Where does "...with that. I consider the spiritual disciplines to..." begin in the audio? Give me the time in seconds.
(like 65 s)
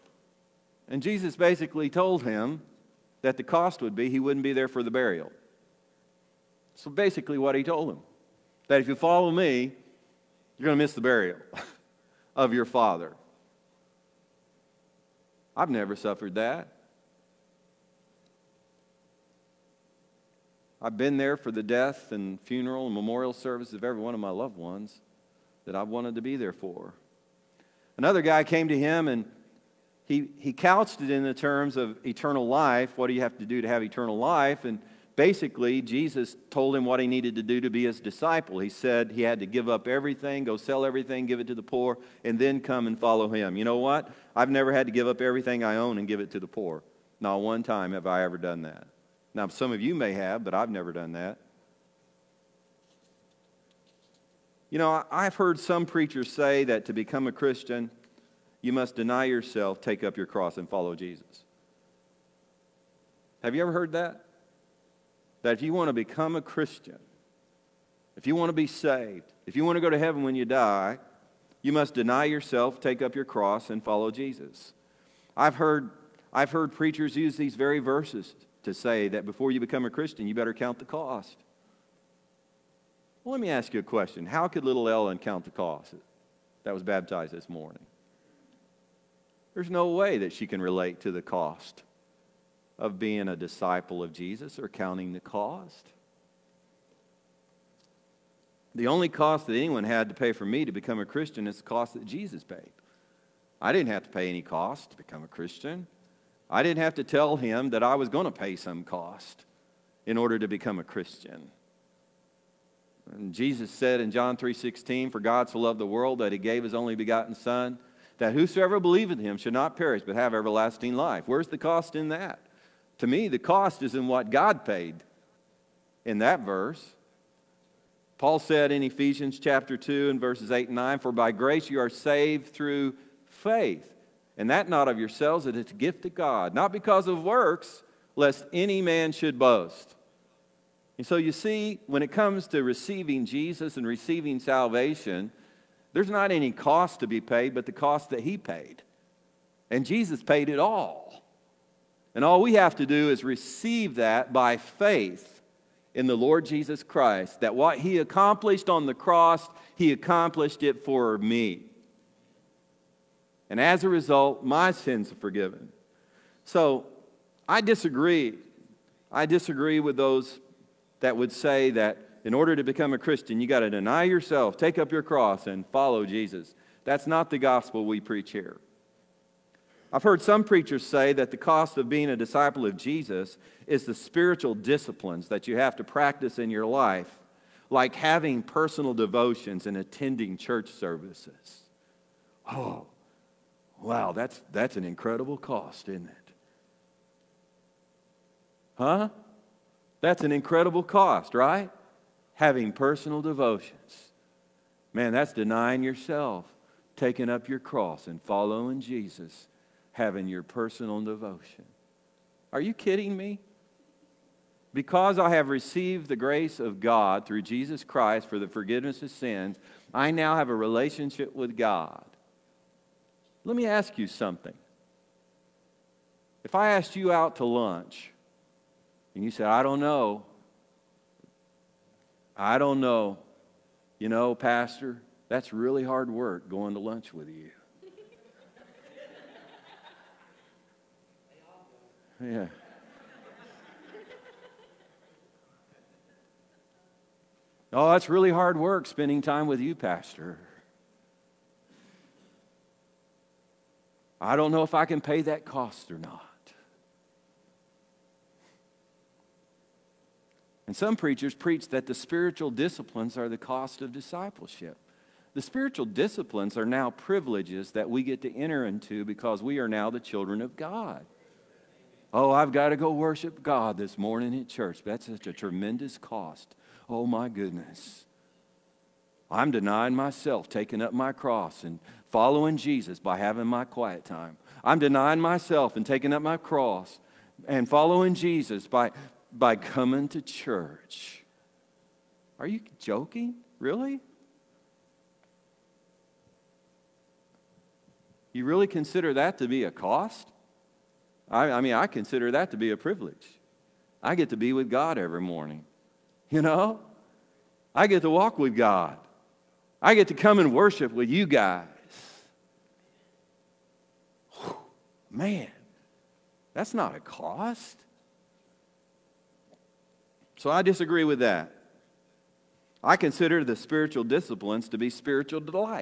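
321 s.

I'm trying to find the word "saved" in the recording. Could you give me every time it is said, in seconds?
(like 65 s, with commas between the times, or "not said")
68 s, 131 s.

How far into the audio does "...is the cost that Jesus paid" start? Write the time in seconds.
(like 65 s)
101 s.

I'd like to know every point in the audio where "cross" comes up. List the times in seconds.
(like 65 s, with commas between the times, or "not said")
60 s, 73 s, 158 s, 175 s, 207 s, 281 s, 286 s.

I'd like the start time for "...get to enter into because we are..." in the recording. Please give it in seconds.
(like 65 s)
268 s.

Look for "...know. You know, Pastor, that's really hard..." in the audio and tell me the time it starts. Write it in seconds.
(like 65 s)
232 s.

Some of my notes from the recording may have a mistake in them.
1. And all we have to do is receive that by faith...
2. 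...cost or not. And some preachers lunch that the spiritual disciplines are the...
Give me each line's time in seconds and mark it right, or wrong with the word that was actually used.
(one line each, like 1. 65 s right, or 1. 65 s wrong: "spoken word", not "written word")
1. 152 s right
2. 255 s wrong: "preach", not "lunch".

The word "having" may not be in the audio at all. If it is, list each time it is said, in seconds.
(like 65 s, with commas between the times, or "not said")
187 s, 202 s, 209 s, 283 s.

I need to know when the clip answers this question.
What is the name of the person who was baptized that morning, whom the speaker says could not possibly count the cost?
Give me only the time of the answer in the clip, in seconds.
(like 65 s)
84 s.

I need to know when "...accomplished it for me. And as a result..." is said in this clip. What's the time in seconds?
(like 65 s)
159 s.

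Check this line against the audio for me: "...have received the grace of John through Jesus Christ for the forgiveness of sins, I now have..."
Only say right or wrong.
wrong.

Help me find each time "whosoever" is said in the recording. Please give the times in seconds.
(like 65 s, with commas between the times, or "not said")
118 s.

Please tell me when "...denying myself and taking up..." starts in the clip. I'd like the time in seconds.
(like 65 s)
284 s.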